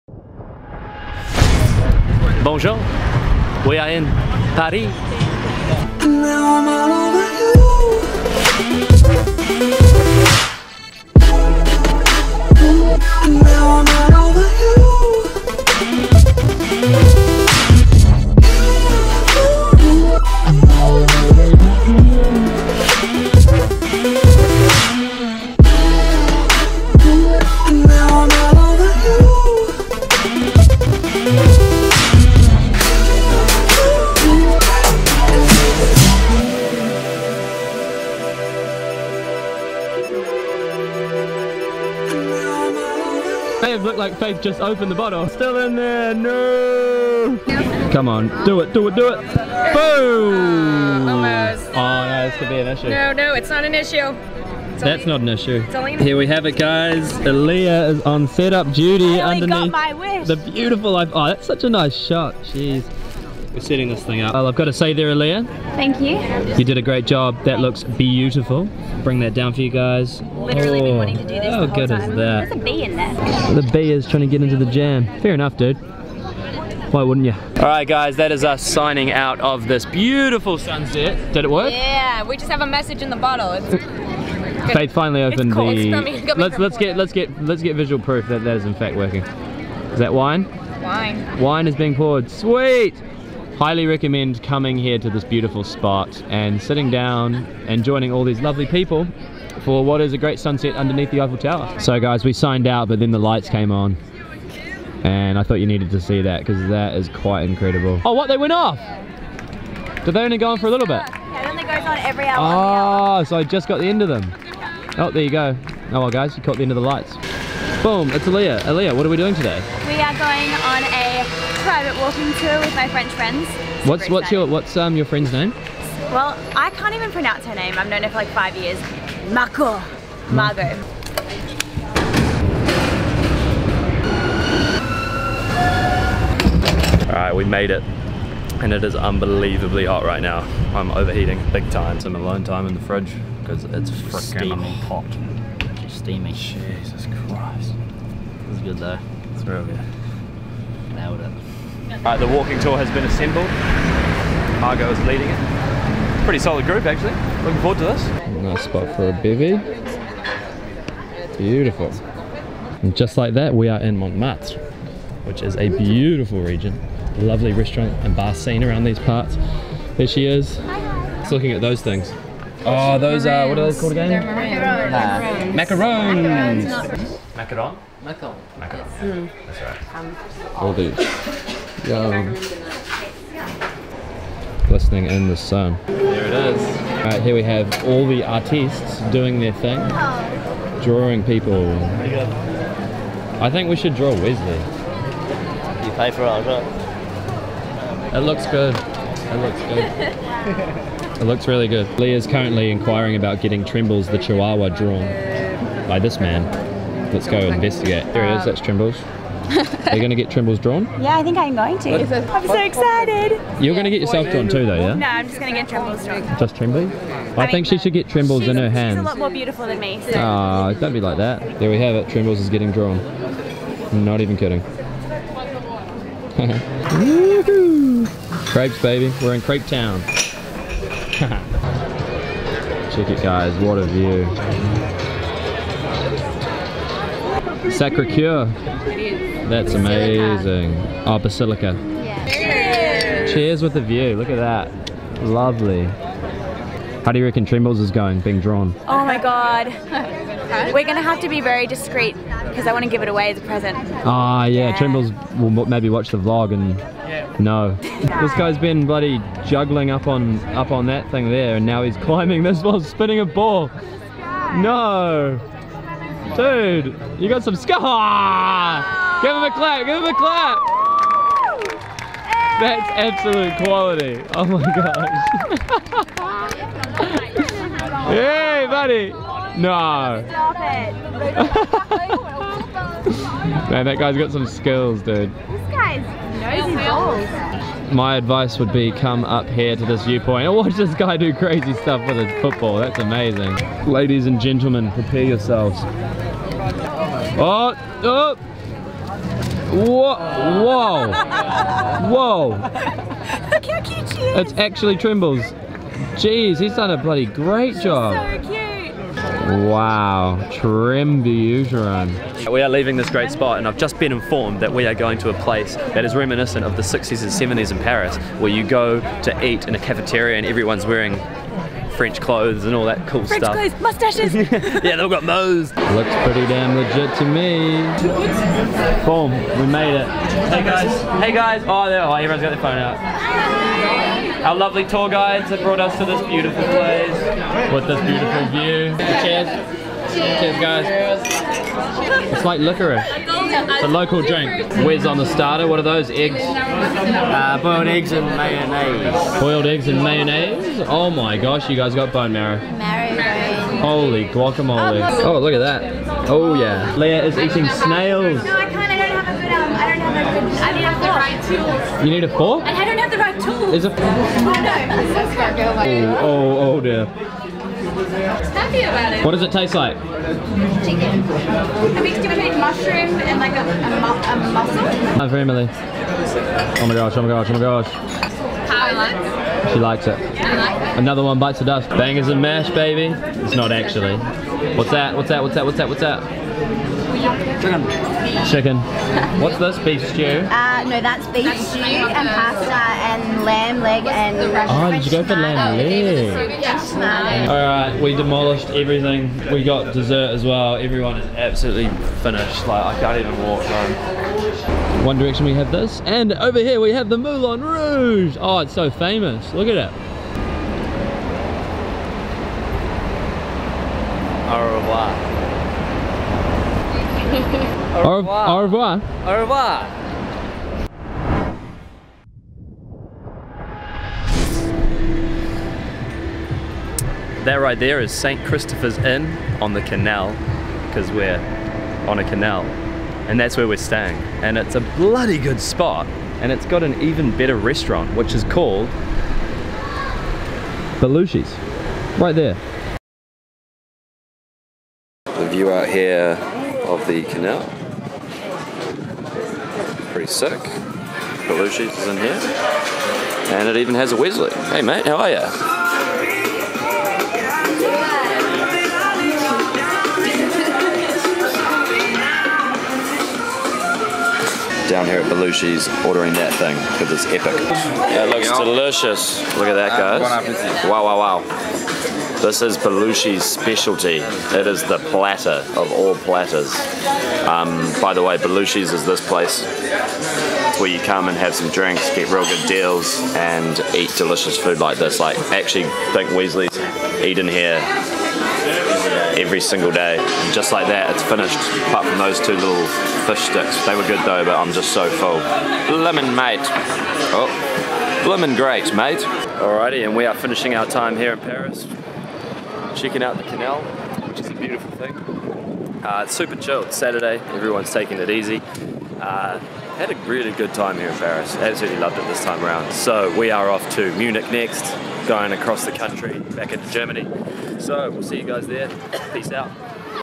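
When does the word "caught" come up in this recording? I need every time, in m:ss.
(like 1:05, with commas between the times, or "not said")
1:56.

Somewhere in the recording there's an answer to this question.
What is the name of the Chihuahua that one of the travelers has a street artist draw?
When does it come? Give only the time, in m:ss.
3:28.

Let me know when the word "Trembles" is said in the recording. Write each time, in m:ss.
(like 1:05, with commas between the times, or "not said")
4:07, 4:14, 5:04.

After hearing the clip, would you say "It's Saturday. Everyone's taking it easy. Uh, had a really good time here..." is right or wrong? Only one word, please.
right.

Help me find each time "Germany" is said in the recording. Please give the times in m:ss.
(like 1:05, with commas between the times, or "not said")
8:36.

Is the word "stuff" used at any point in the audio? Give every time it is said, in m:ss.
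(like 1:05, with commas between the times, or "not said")
4:51, 5:23.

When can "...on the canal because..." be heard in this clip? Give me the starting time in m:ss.
7:09.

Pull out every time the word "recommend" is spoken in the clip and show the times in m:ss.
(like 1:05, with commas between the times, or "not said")
1:33.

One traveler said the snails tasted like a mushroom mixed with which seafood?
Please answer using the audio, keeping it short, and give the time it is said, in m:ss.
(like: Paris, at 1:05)
A mussel, at 6:14.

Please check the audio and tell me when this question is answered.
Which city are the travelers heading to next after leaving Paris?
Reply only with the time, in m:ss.
8:34.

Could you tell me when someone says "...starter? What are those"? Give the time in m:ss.
5:45.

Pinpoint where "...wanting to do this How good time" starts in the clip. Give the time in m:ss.
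1:10.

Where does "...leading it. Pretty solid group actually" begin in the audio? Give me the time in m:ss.
2:35.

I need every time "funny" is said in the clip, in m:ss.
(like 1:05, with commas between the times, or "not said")
not said.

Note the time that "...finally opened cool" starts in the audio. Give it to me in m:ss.
1:24.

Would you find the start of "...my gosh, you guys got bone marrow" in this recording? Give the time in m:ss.
5:51.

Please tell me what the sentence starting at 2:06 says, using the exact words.
Well, I can't even pronounce her name.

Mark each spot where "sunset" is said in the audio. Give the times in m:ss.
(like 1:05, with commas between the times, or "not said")
1:20, 1:40.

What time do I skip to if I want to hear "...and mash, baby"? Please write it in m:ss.
6:22.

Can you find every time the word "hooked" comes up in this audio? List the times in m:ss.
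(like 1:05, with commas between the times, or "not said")
not said.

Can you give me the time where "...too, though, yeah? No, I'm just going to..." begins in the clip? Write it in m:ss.
3:34.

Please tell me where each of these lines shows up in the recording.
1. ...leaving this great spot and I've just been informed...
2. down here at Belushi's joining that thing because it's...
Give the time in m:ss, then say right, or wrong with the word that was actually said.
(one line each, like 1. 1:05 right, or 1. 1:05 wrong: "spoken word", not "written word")
1. 5:12 right
2. 7:44 wrong: "ordering", not "joining".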